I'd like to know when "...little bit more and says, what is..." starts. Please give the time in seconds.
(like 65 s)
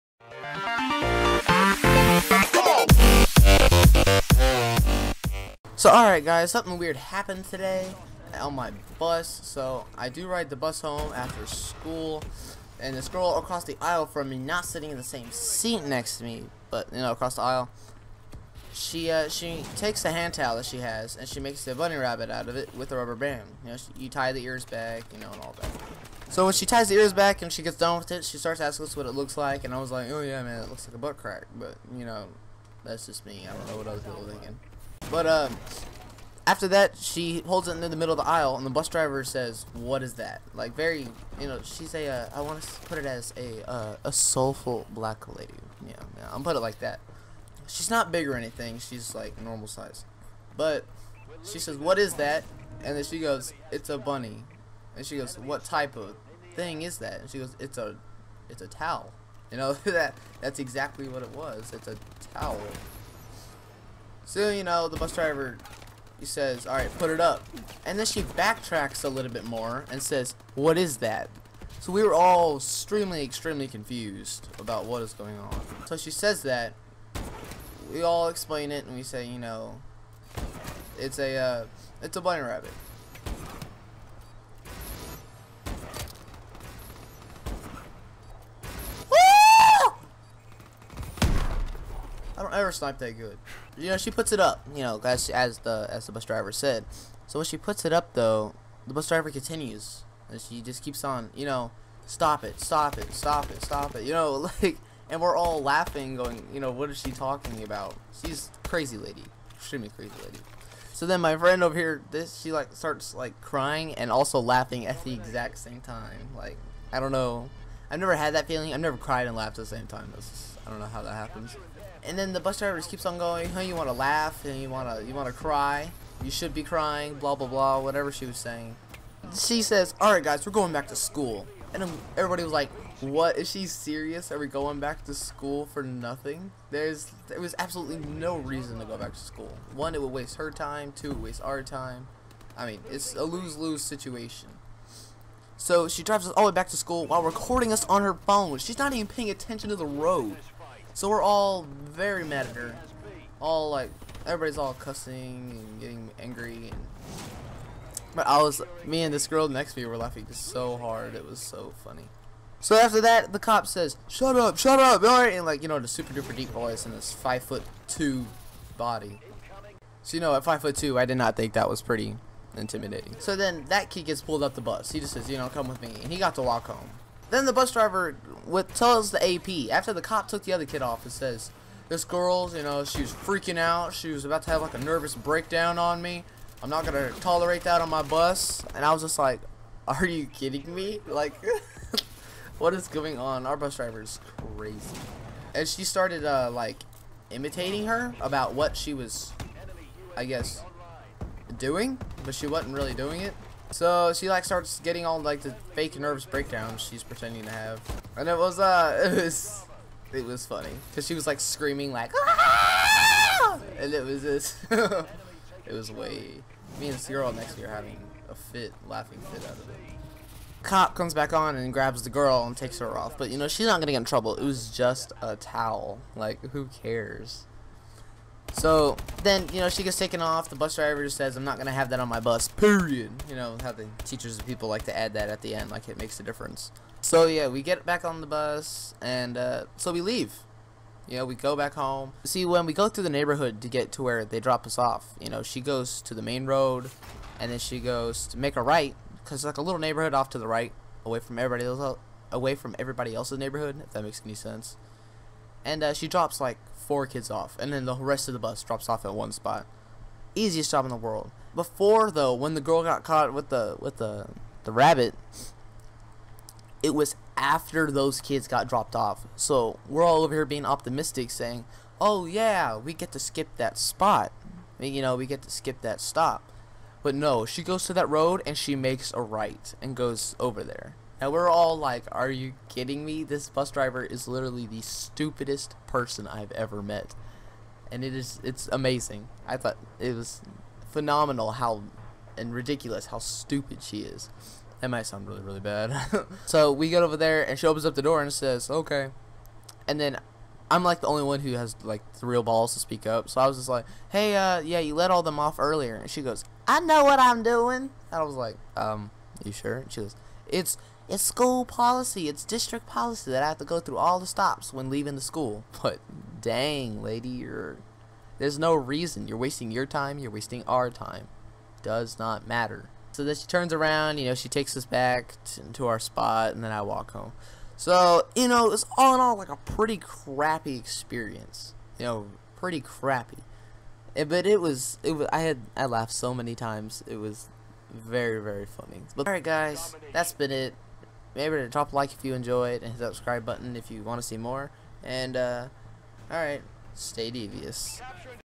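69 s.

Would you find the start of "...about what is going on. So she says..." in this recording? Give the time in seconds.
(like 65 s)
74 s.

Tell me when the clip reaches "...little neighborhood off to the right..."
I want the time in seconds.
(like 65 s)
249 s.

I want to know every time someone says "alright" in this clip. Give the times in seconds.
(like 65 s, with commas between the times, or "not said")
5 s, 165 s, 339 s, 346 s.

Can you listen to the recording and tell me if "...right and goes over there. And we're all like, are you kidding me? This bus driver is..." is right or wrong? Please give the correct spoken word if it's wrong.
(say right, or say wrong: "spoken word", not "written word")
right.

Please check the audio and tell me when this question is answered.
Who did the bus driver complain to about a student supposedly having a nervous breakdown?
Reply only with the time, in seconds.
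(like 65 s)
179 s.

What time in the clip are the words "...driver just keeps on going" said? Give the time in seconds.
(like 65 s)
122 s.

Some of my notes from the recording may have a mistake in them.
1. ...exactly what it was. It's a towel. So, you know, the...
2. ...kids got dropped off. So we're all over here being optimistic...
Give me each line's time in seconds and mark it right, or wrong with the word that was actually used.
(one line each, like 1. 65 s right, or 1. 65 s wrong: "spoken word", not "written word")
1. 60 s right
2. 268 s right.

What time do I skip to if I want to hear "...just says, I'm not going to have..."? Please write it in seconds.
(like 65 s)
231 s.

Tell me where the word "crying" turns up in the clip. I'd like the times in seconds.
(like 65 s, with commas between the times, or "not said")
113 s, 126 s.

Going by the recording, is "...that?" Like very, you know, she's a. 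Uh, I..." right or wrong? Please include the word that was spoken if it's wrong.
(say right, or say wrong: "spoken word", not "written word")
right.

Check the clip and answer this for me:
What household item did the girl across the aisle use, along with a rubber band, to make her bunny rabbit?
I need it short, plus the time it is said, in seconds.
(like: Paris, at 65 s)
Hand towel, at 20 s.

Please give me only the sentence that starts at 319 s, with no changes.
You're wasting your time, you're wasting our time.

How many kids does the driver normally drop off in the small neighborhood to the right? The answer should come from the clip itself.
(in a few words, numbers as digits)
4.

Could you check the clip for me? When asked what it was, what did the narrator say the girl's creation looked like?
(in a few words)
A butt crack.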